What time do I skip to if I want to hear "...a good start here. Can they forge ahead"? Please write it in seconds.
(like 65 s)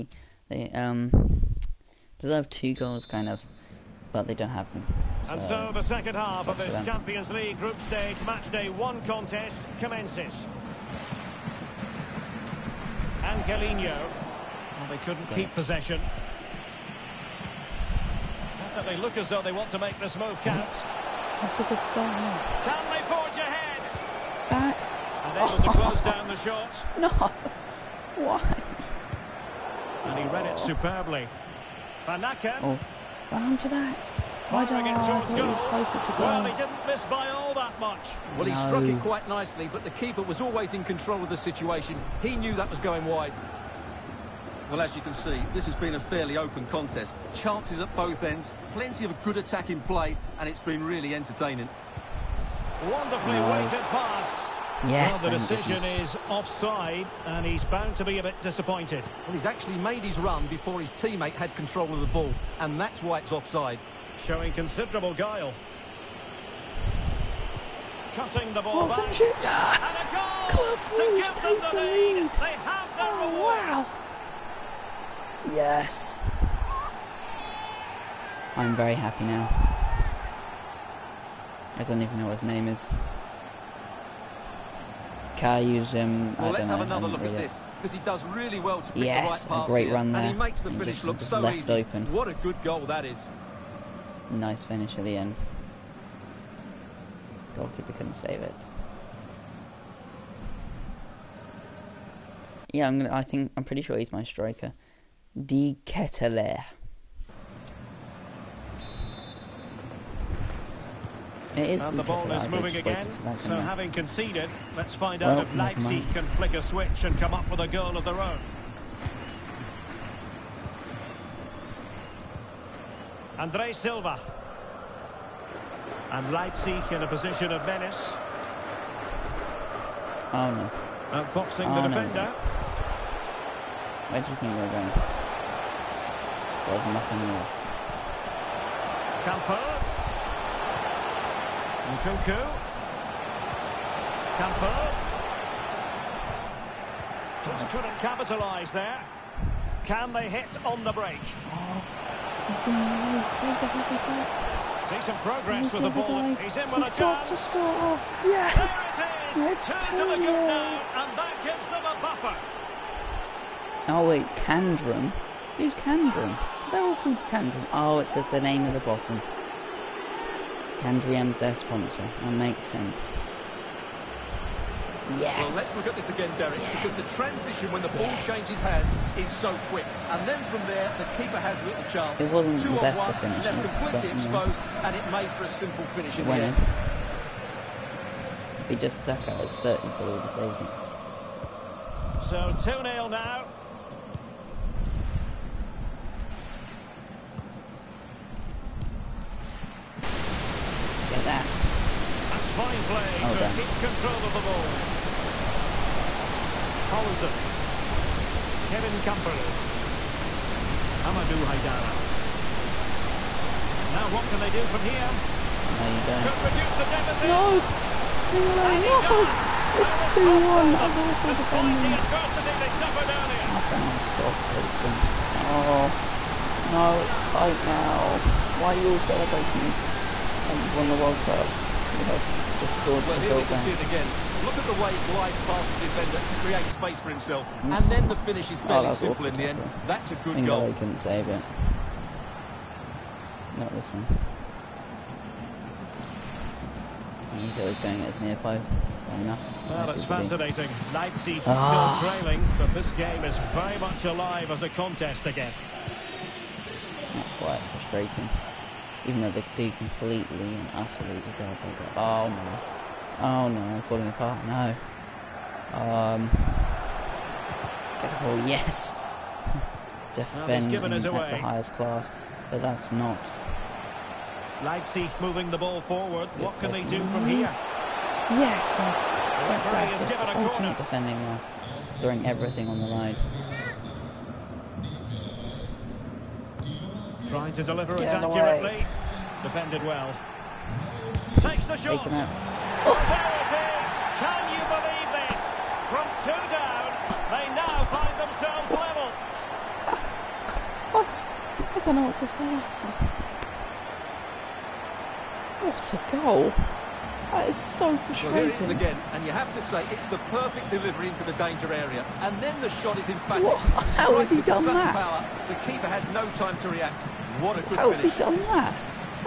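21 s.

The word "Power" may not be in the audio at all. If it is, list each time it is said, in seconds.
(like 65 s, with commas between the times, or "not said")
314 s.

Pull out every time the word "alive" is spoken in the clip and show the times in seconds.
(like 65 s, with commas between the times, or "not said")
254 s.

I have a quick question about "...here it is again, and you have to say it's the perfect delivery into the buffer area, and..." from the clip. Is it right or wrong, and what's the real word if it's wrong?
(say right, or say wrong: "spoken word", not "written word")
wrong: "danger", not "buffer".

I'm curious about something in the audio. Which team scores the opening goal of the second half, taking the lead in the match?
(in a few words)
Club Bruges.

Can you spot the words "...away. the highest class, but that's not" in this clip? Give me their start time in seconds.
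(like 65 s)
271 s.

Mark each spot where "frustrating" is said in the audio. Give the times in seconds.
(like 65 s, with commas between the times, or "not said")
257 s, 307 s.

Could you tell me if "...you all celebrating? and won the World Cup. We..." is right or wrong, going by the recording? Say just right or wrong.
right.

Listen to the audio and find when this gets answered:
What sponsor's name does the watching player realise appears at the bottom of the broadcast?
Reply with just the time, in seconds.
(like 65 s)
170 s.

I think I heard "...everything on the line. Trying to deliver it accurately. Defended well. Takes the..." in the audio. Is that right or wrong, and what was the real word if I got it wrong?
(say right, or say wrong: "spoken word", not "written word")
right.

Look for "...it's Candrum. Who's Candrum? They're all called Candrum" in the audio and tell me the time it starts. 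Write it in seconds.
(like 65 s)
164 s.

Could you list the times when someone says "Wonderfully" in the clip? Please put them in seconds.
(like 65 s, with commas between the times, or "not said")
52 s.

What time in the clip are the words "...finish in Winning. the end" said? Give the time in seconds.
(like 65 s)
185 s.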